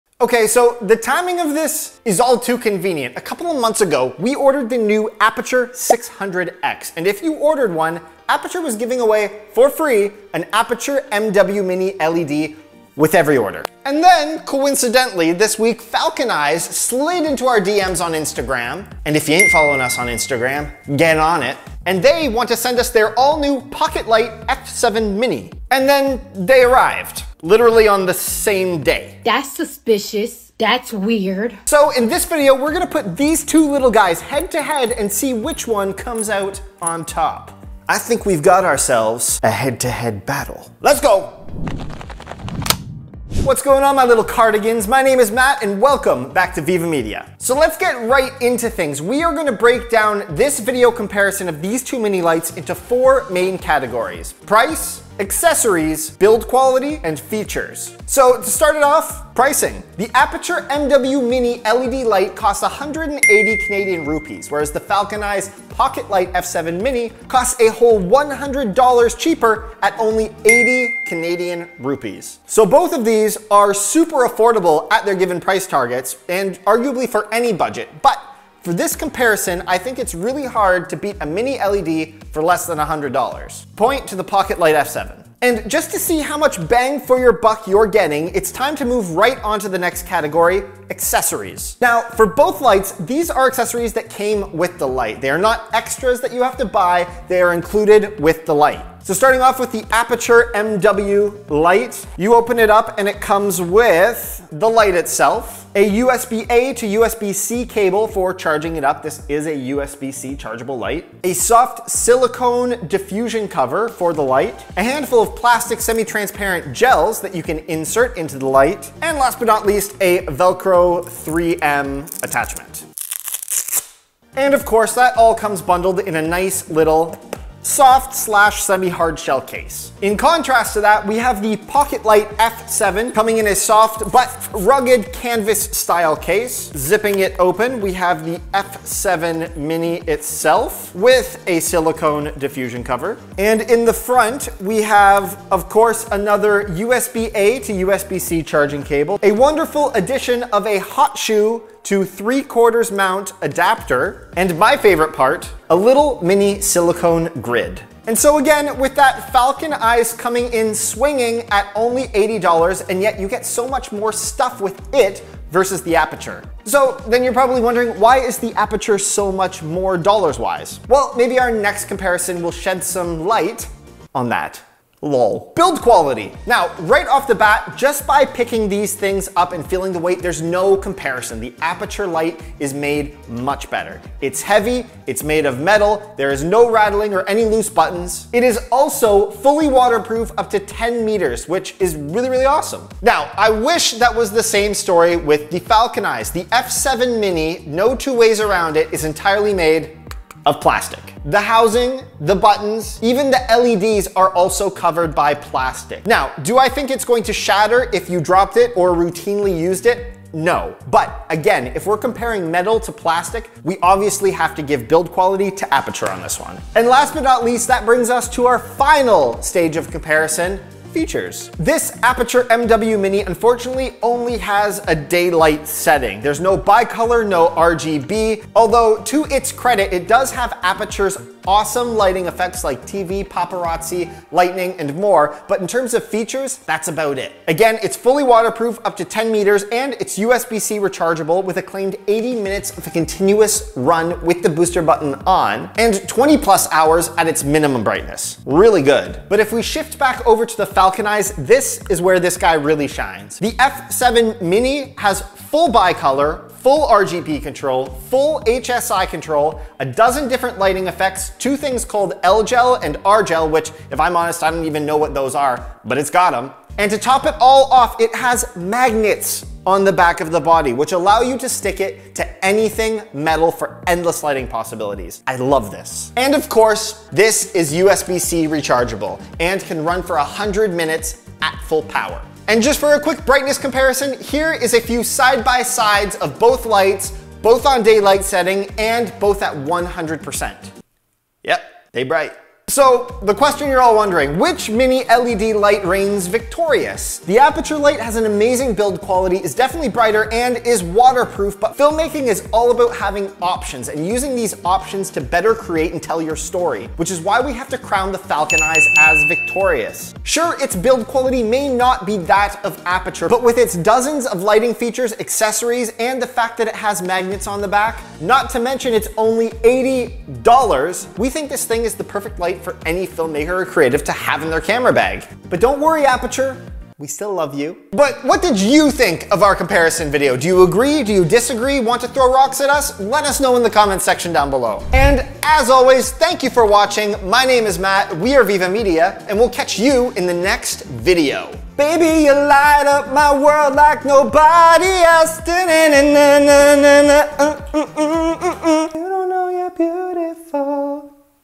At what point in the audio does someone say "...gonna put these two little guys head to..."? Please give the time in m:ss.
0:32.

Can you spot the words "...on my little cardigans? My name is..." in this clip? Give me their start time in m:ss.
0:43.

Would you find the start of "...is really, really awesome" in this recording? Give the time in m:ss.
3:11.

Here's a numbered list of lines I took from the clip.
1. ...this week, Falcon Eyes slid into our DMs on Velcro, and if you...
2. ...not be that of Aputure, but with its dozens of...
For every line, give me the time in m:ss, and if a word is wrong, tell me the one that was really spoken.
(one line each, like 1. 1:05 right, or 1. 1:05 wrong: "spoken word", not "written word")
1. 0:15 wrong: "Instagram", not "Velcro"
2. 5:11 right.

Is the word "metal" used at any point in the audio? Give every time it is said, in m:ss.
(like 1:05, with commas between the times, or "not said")
3:05, 3:32, 4:33.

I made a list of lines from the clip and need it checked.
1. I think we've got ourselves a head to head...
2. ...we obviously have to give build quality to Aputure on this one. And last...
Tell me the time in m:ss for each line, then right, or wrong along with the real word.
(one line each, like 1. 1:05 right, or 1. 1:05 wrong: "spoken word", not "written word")
1. 0:37 right
2. 3:33 right.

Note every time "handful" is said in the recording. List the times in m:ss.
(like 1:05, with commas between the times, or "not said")
1:54.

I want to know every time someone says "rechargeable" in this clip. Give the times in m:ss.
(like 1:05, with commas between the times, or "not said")
4:00, 4:38.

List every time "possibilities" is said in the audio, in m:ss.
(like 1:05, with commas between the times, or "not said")
4:34.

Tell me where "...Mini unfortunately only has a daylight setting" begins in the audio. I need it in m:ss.
3:42.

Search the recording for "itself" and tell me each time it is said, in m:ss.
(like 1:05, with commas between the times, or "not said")
1:44, 2:20.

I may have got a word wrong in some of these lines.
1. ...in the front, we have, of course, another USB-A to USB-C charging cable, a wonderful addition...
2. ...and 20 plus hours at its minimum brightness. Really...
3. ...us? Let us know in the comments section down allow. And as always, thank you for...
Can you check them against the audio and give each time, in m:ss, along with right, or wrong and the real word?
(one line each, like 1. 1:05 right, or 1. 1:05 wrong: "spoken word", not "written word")
1. 2:23 right
2. 4:05 right
3. 5:32 wrong: "below", not "allow".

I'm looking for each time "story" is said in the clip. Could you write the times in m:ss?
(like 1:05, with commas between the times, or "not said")
3:14, 5:06.